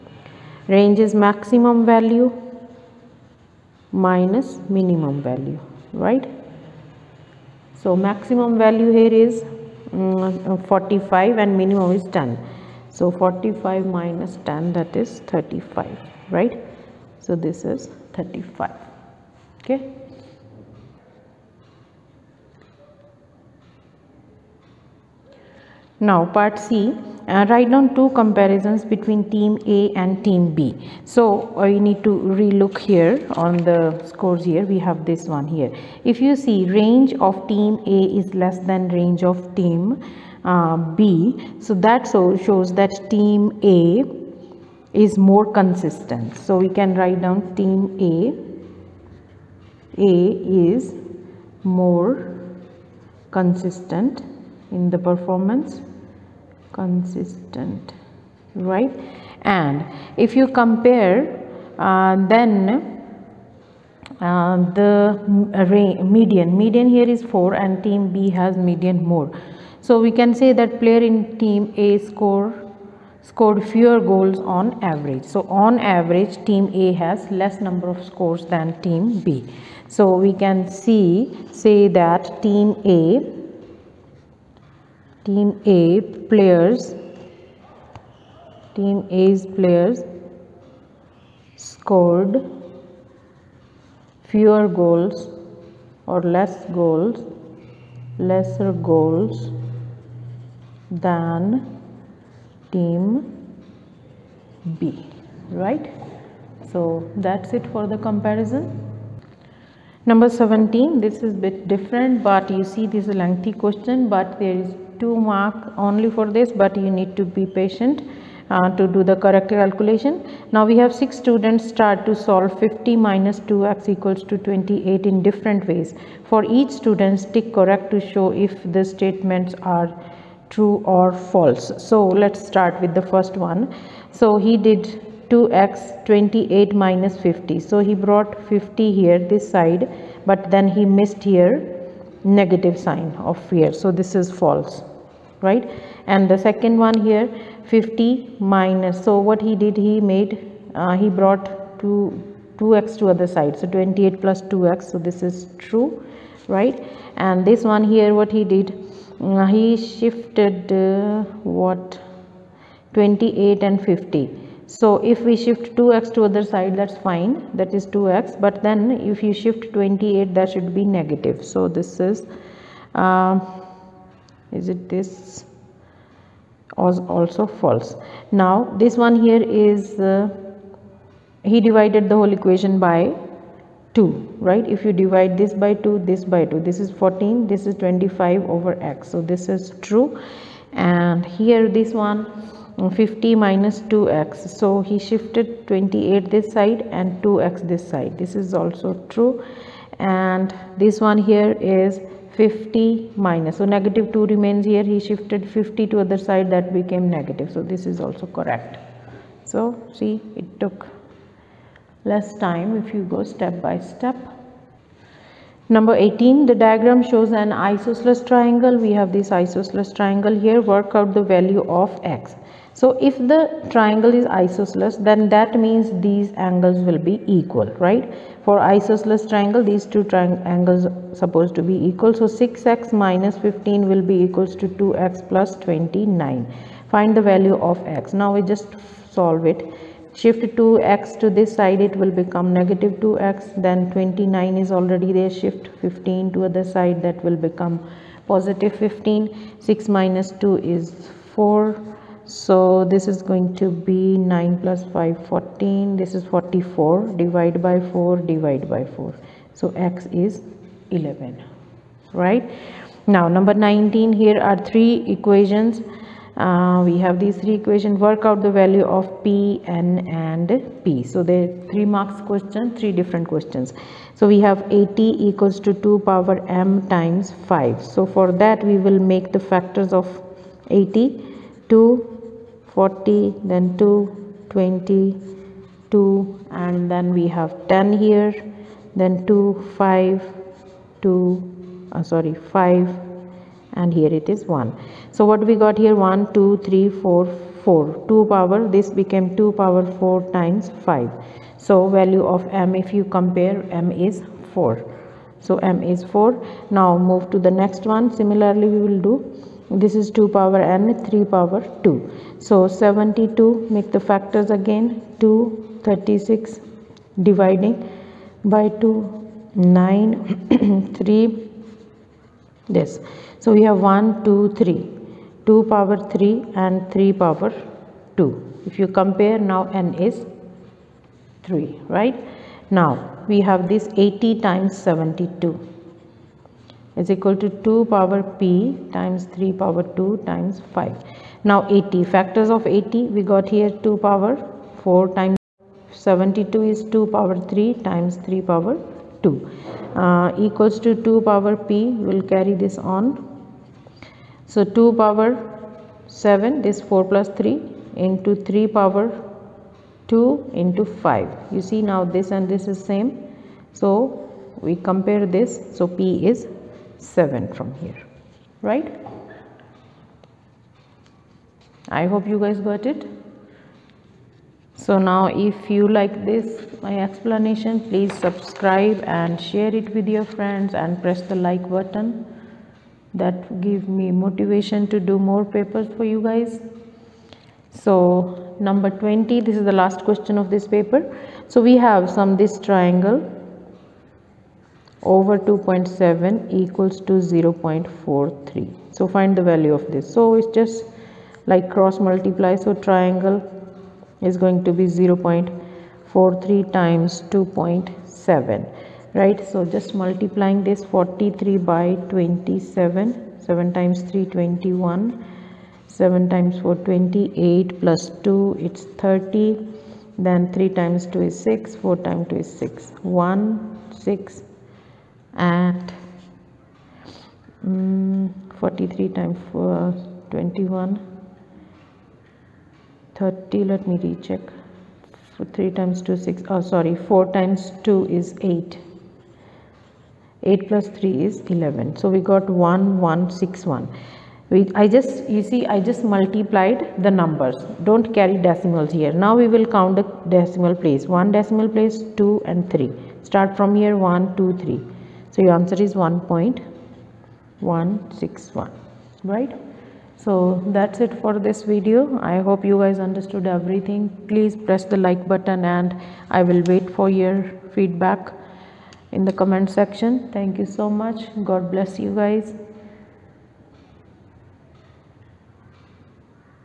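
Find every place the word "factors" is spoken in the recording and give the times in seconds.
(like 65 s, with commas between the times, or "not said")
279 s, 313 s, 342 s.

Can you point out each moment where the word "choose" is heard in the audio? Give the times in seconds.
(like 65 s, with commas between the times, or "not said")
not said.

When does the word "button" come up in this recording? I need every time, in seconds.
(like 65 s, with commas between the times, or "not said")
381 s, 465 s.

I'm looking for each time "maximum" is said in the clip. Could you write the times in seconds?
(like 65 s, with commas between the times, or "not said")
1 s, 8 s.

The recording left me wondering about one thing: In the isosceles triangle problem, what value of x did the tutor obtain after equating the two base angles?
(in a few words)
11.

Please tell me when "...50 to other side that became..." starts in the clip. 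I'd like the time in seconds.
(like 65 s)
205 s.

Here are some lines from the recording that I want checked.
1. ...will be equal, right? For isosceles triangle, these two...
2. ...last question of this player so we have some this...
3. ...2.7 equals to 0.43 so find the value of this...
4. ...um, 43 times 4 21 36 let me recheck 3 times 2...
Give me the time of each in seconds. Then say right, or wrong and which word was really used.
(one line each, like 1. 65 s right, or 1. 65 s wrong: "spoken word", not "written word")
1. 226 s right
2. 389 s wrong: "paper", not "player"
3. 395 s right
4. 427 s wrong: "30", not "36".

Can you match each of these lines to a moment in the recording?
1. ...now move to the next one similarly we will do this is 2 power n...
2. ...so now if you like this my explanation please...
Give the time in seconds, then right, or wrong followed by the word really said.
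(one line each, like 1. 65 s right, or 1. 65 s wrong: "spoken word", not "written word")
1. 306 s right
2. 374 s right.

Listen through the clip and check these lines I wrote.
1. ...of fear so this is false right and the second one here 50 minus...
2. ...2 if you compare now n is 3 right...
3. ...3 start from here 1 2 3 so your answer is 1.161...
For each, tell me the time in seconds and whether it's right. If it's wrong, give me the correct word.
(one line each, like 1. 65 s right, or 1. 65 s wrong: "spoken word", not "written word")
1. 143 s right
2. 327 s right
3. 452 s right.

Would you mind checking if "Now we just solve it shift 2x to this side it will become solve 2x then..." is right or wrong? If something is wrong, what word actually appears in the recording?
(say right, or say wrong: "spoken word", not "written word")
wrong: "negative", not "solve".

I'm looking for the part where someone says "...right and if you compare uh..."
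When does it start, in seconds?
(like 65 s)
58 s.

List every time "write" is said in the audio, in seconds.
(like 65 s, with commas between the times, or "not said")
27 s, 46 s.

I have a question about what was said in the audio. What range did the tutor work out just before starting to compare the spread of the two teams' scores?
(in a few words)
35.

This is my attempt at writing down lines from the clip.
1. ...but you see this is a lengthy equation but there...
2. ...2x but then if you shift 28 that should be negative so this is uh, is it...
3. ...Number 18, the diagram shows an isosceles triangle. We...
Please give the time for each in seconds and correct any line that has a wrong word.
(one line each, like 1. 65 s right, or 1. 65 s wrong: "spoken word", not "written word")
1. 112 s wrong: "question", not "equation"
2. 167 s right
3. 215 s right.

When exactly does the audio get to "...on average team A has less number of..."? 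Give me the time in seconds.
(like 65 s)
75 s.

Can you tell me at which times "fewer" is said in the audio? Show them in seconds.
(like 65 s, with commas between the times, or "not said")
73 s, 94 s.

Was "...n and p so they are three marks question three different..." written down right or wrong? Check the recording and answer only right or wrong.
right.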